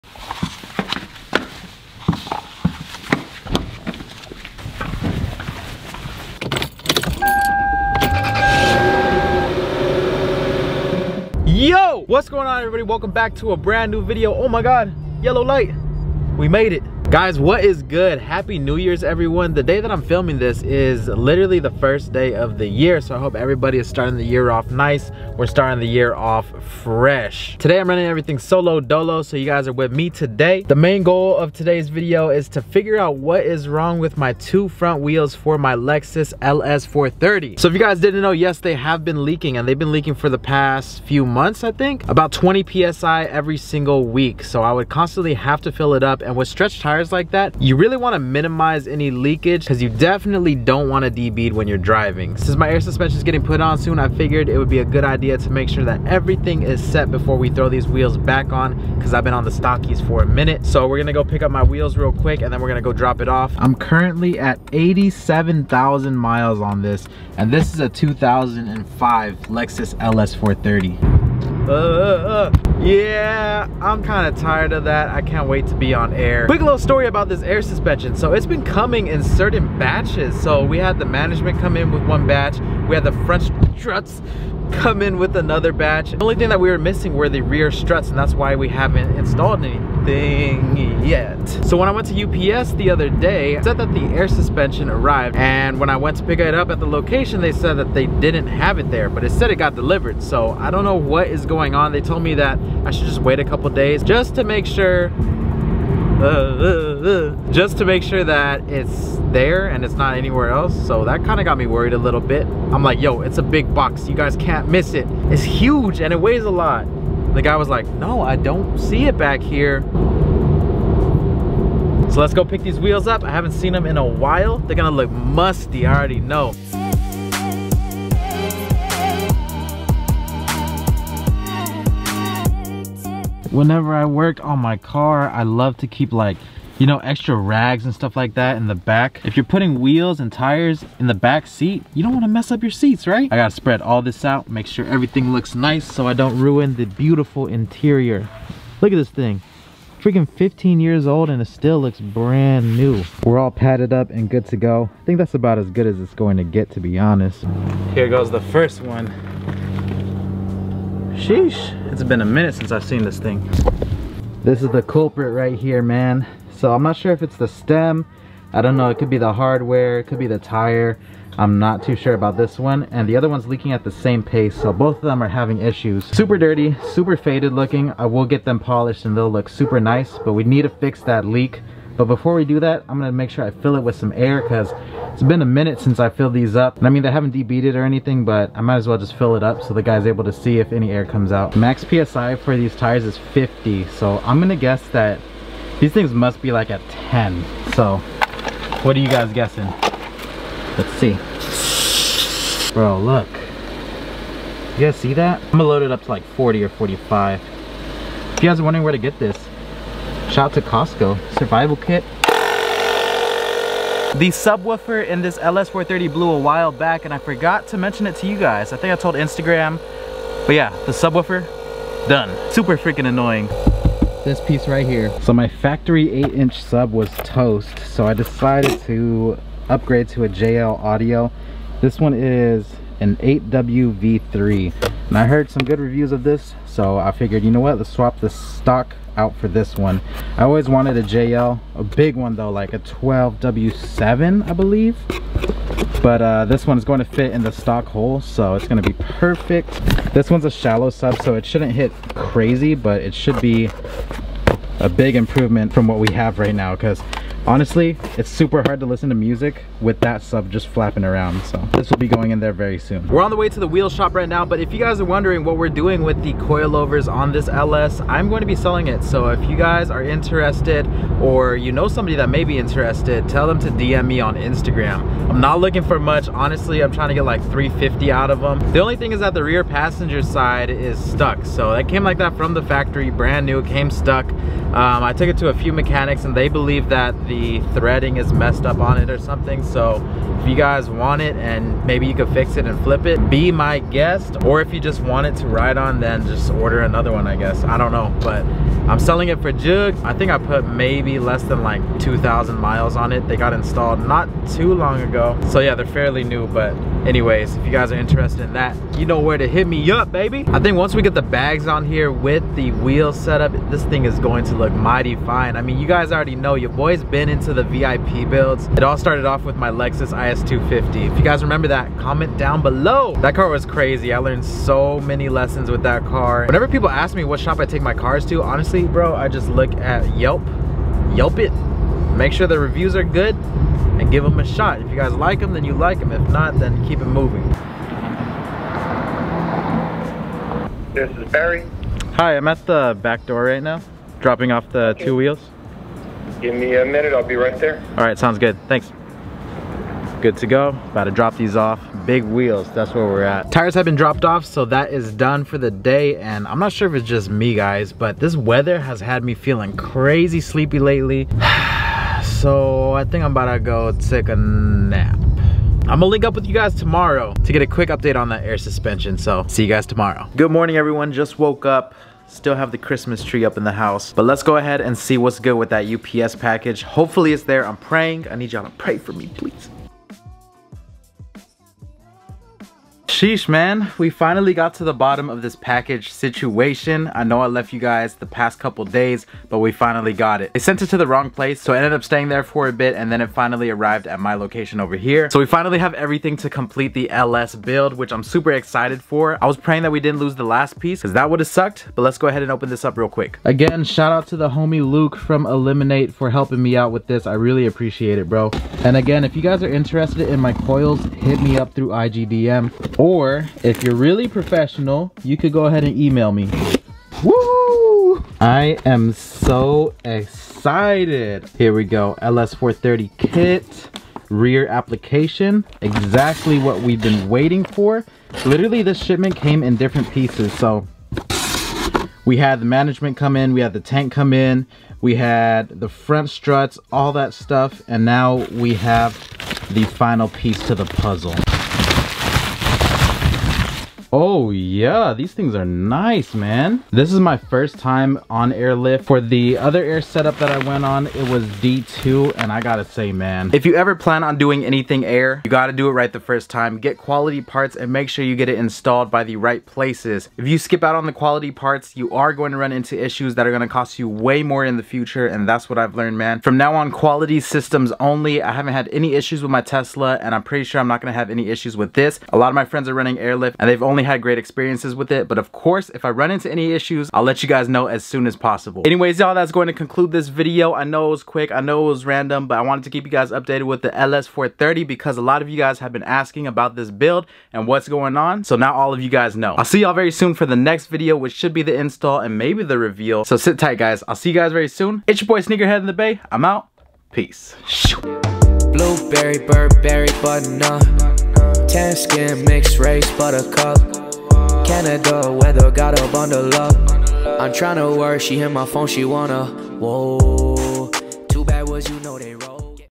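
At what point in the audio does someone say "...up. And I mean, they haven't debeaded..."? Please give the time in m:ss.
3:06.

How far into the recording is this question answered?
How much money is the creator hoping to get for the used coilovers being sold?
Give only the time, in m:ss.
4:37.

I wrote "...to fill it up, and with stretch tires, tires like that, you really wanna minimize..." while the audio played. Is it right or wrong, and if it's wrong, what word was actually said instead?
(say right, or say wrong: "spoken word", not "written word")
right.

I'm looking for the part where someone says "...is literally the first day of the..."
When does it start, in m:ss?
0:20.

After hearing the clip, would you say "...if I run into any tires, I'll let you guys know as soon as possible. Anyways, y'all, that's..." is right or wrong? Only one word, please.
wrong.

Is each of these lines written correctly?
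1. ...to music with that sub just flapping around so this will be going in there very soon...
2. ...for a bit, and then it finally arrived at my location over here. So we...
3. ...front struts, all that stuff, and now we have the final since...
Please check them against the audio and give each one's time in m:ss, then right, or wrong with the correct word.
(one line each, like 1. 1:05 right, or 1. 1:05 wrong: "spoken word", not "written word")
1. 4:19 right
2. 6:32 right
3. 7:15 wrong: "piece", not "since".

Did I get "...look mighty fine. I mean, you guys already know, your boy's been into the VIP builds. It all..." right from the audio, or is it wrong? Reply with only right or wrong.
right.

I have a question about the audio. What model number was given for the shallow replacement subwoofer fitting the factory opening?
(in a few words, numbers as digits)
8WV3.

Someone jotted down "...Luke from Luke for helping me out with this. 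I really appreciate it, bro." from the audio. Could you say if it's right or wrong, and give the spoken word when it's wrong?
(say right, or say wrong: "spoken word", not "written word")
wrong: "Illiminate", not "Luke".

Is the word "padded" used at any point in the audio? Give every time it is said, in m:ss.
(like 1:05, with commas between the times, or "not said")
2:33.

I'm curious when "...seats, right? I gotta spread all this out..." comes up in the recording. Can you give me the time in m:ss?
2:22.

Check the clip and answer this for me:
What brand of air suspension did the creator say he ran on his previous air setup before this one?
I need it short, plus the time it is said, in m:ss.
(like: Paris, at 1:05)
D2, at 7:31.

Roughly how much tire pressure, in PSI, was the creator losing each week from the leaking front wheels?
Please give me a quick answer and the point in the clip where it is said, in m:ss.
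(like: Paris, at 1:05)
20 PSI, at 0:42.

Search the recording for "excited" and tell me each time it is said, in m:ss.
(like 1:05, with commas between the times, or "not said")
6:38, 7:00.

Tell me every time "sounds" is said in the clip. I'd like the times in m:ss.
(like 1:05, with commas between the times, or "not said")
5:48.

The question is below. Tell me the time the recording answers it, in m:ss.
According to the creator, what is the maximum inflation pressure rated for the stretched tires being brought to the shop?
3:13.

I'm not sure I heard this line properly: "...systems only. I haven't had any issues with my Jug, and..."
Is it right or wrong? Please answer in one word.
wrong.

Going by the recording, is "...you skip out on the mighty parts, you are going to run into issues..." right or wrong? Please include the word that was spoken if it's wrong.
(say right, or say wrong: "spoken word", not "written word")
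wrong: "quality", not "mighty".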